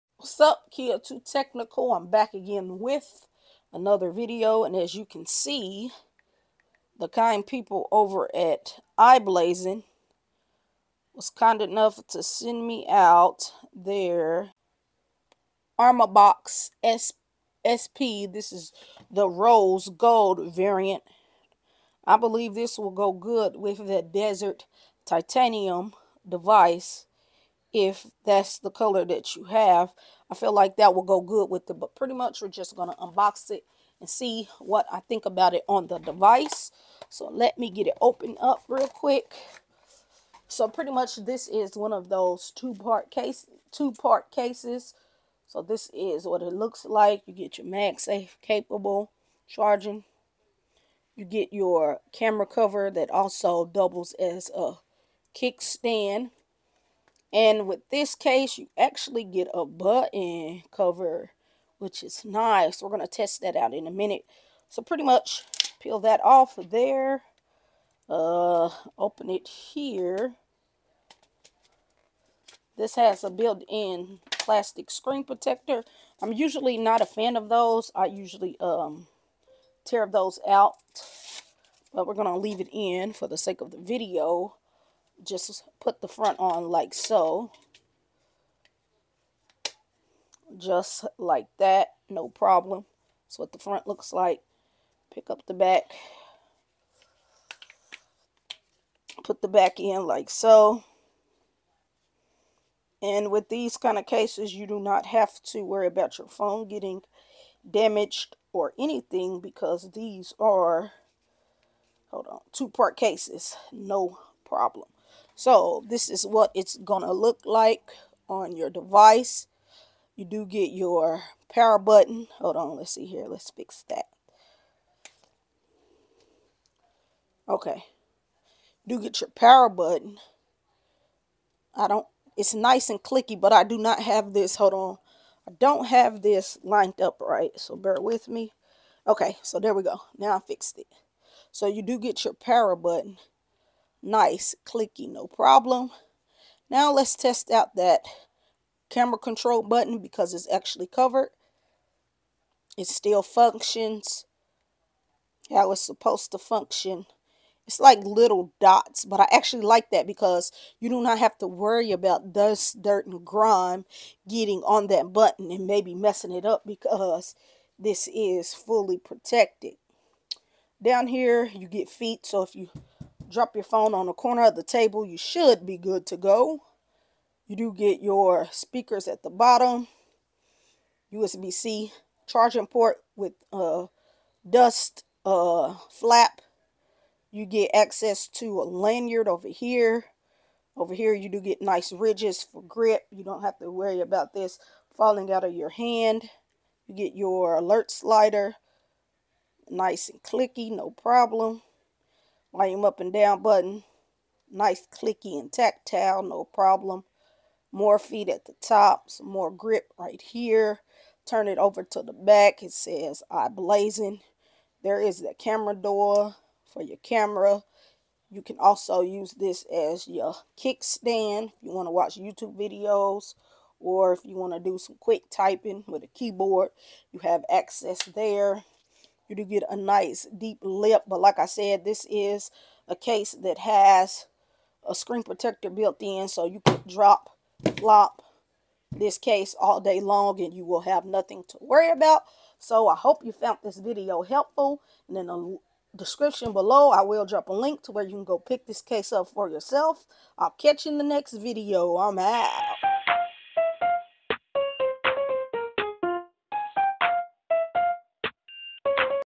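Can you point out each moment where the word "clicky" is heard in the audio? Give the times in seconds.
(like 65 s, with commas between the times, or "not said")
133 s, 144 s, 200 s, 204 s.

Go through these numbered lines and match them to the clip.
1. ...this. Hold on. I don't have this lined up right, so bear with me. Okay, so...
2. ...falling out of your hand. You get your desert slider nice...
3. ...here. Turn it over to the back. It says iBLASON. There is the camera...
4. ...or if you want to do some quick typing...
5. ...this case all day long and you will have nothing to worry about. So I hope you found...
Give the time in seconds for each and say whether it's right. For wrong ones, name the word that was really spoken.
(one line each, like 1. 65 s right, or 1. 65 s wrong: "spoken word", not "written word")
1. 134 s right
2. 194 s wrong: "alert", not "desert"
3. 210 s right
4. 223 s right
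5. 238 s right.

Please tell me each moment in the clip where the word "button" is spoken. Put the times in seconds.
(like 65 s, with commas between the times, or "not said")
59 s, 121 s, 129 s, 142 s, 149 s, 165 s, 203 s.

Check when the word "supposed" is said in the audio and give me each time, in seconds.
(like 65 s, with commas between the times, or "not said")
155 s.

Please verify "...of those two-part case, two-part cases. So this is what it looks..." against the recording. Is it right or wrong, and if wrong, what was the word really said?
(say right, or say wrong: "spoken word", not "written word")
right.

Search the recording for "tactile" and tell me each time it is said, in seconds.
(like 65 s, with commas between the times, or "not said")
205 s.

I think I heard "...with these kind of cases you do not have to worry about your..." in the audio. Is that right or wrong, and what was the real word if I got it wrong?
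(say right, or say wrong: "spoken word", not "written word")
right.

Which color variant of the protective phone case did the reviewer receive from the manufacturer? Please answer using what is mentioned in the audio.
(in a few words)
Rose gold.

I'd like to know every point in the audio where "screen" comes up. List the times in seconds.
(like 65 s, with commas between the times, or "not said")
74 s, 234 s.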